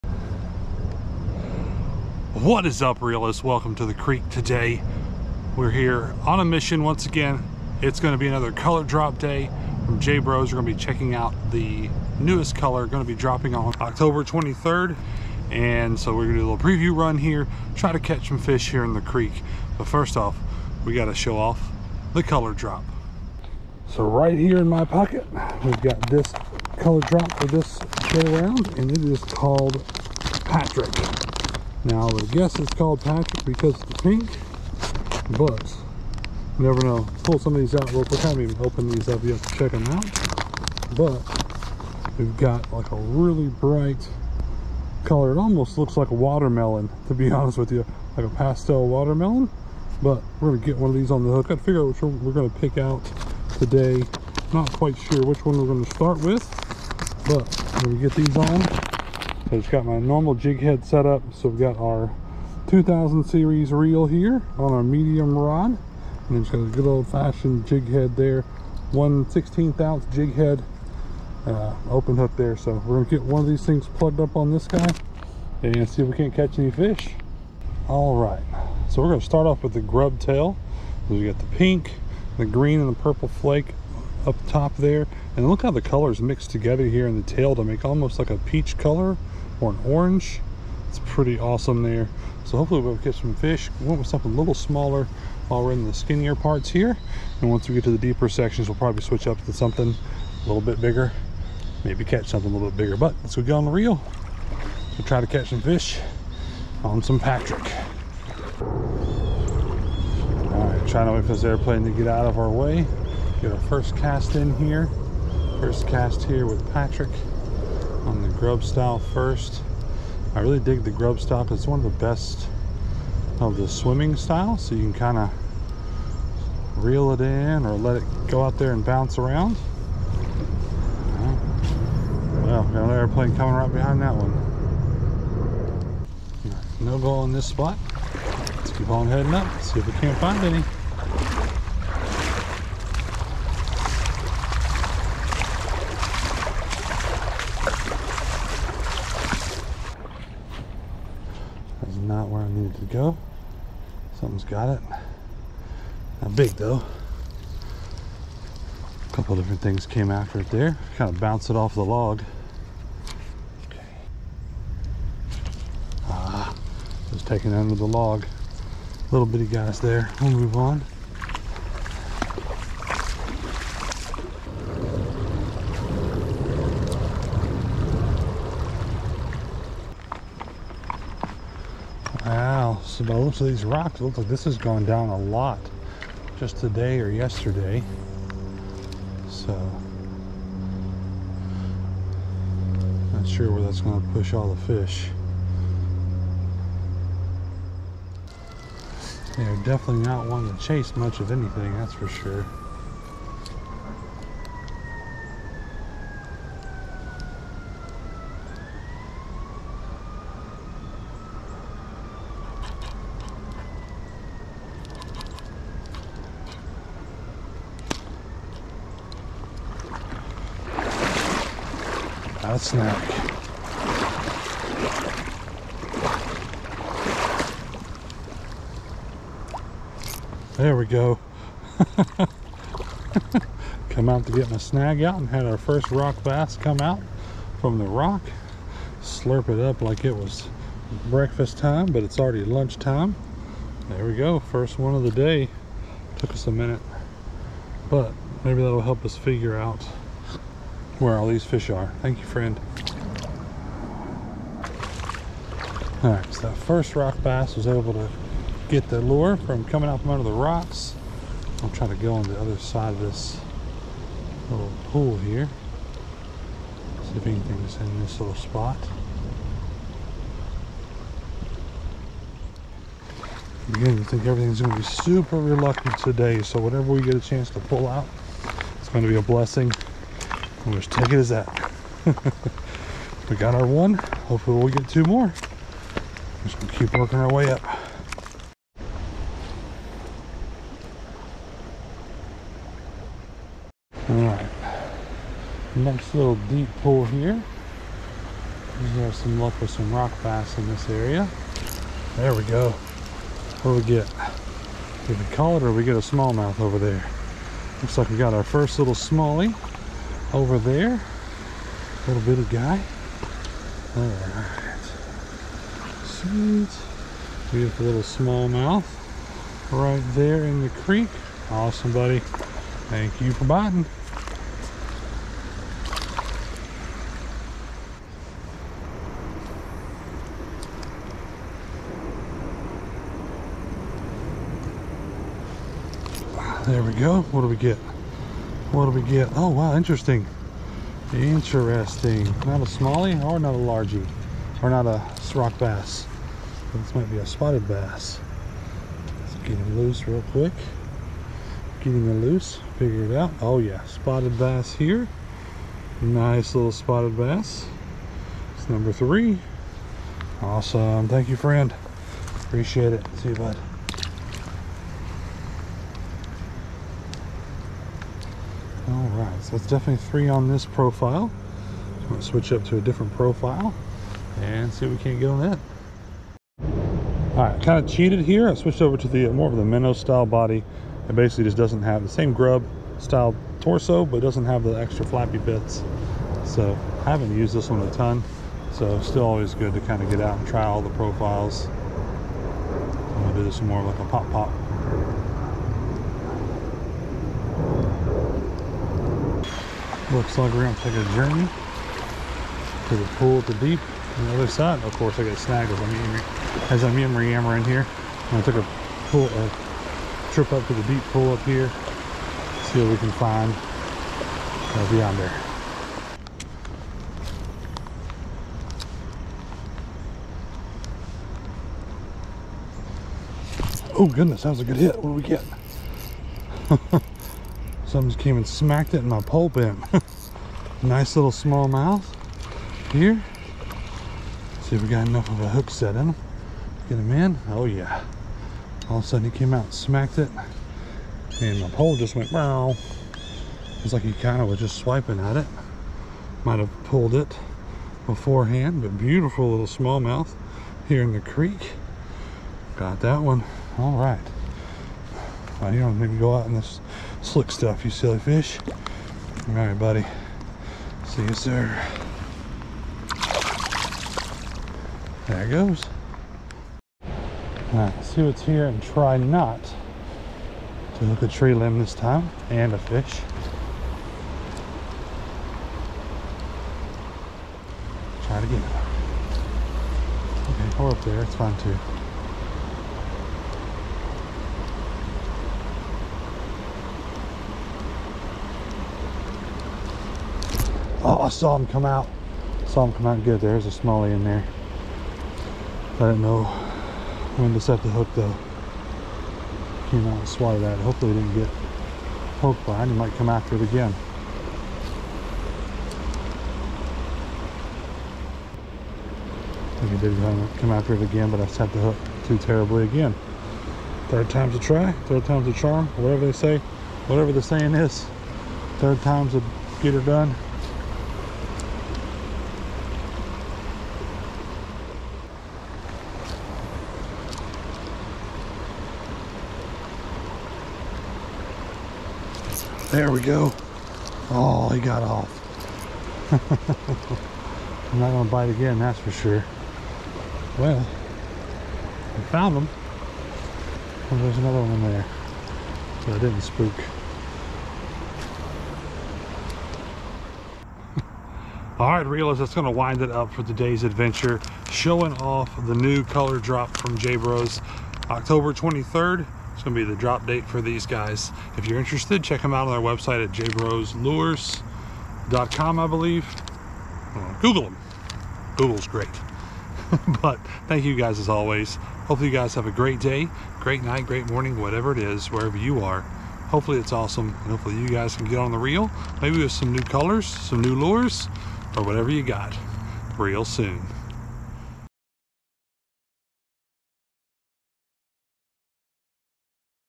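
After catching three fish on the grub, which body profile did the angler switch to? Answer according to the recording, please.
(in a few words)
minnow style.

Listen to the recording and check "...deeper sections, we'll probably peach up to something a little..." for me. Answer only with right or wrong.
wrong.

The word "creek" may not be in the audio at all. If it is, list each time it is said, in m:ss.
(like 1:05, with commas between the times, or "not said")
0:03, 0:19, 5:20, 7:31.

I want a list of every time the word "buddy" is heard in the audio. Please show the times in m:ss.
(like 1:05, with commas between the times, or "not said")
5:21, 7:39.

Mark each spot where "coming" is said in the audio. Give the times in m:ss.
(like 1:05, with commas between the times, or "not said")
2:13, 4:19.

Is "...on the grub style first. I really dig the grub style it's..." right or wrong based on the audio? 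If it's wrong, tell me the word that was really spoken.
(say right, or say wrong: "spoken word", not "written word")
right.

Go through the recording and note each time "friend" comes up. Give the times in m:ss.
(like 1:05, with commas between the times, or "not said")
4:12, 6:01.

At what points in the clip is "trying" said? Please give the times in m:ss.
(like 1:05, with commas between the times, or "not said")
1:50.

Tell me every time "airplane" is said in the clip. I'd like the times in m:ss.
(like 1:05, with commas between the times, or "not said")
1:51, 2:12.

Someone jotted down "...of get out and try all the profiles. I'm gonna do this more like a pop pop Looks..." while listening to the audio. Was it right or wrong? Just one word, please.
right.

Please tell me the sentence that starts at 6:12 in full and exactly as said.
I'm gonna switch up to a different profile and see if we can't get on that.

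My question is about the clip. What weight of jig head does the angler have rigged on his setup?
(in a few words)
1/16 ounce.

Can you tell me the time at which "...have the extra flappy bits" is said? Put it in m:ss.
6:24.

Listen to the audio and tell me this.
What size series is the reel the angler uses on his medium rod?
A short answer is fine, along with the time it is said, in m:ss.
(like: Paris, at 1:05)
2000, at 1:02.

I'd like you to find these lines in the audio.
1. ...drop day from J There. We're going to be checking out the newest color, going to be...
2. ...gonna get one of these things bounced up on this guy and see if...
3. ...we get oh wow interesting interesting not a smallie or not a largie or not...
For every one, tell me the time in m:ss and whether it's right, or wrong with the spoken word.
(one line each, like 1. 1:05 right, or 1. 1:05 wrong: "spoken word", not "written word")
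1. 0:08 wrong: "Bros", not "There"
2. 1:13 wrong: "plugged", not "bounced"
3. 5:38 right.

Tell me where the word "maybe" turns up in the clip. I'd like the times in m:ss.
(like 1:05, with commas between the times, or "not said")
1:41, 4:08, 9:39.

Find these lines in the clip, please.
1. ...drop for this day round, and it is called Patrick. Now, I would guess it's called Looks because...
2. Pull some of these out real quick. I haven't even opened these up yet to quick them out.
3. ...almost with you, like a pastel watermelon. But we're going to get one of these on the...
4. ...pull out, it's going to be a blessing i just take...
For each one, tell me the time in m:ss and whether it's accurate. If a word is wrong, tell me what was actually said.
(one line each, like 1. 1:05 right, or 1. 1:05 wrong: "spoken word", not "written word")
1. 0:27 wrong: "Patrick", not "Looks"
2. 0:37 wrong: "check", not "quick"
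3. 0:47 wrong: "honest", not "almost"
4. 4:37 right.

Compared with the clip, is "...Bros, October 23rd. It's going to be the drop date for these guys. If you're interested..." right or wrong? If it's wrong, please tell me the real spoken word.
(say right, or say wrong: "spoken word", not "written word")
right.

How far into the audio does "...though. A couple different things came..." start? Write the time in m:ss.
2:36.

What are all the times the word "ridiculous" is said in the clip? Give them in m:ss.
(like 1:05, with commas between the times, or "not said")
not said.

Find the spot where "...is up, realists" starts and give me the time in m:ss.
0:02.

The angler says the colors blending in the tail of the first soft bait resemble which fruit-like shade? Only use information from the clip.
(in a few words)
peach.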